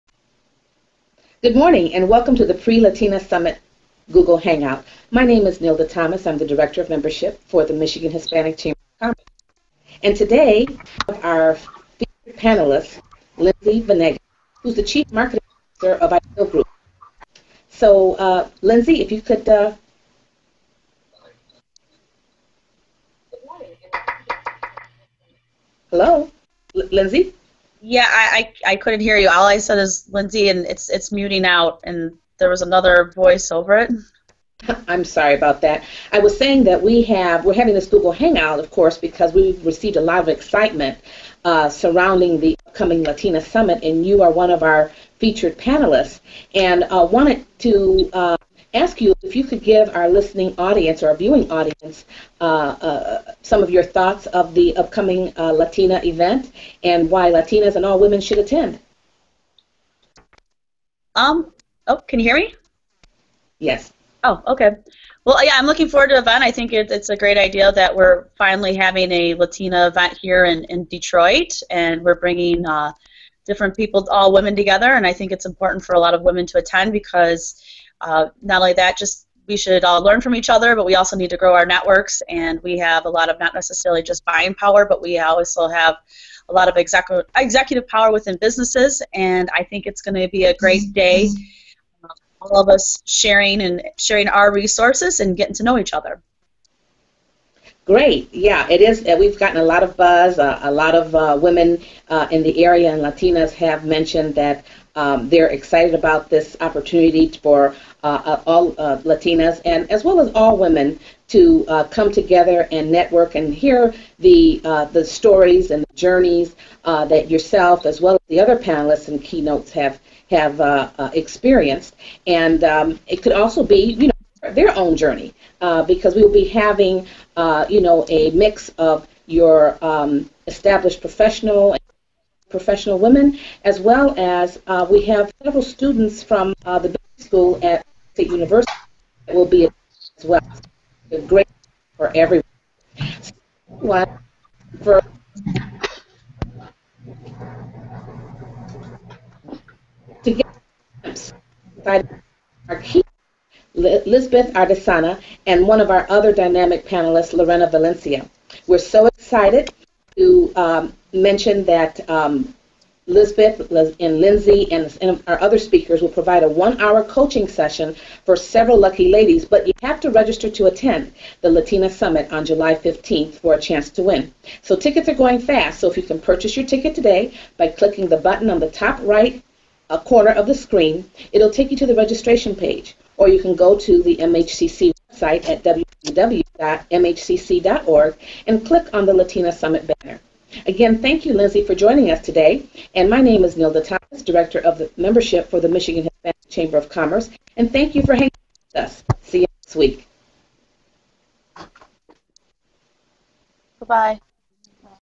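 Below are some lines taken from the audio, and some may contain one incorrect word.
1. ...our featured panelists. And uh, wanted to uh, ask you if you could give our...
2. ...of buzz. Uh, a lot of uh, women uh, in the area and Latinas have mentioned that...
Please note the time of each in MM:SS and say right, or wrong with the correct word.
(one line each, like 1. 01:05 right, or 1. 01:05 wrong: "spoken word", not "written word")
1. 00:44 right
2. 01:39 right.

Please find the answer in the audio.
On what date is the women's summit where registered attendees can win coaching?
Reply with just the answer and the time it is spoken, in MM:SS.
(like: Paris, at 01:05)
July 15, at 02:52.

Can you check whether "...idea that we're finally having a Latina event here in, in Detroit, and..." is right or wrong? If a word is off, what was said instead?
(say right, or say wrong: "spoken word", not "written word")
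right.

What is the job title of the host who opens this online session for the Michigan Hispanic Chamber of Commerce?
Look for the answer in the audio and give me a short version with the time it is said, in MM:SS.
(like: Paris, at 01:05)
Director of Membership, at 00:06.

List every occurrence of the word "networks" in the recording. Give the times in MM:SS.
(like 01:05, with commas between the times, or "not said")
01:21, 01:52.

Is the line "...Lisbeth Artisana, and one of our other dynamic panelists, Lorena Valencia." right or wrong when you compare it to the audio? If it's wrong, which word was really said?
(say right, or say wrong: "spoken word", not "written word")
right.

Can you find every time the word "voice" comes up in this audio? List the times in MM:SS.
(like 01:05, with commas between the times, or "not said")
00:33.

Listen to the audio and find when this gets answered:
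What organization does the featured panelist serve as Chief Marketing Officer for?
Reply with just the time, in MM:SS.
00:16.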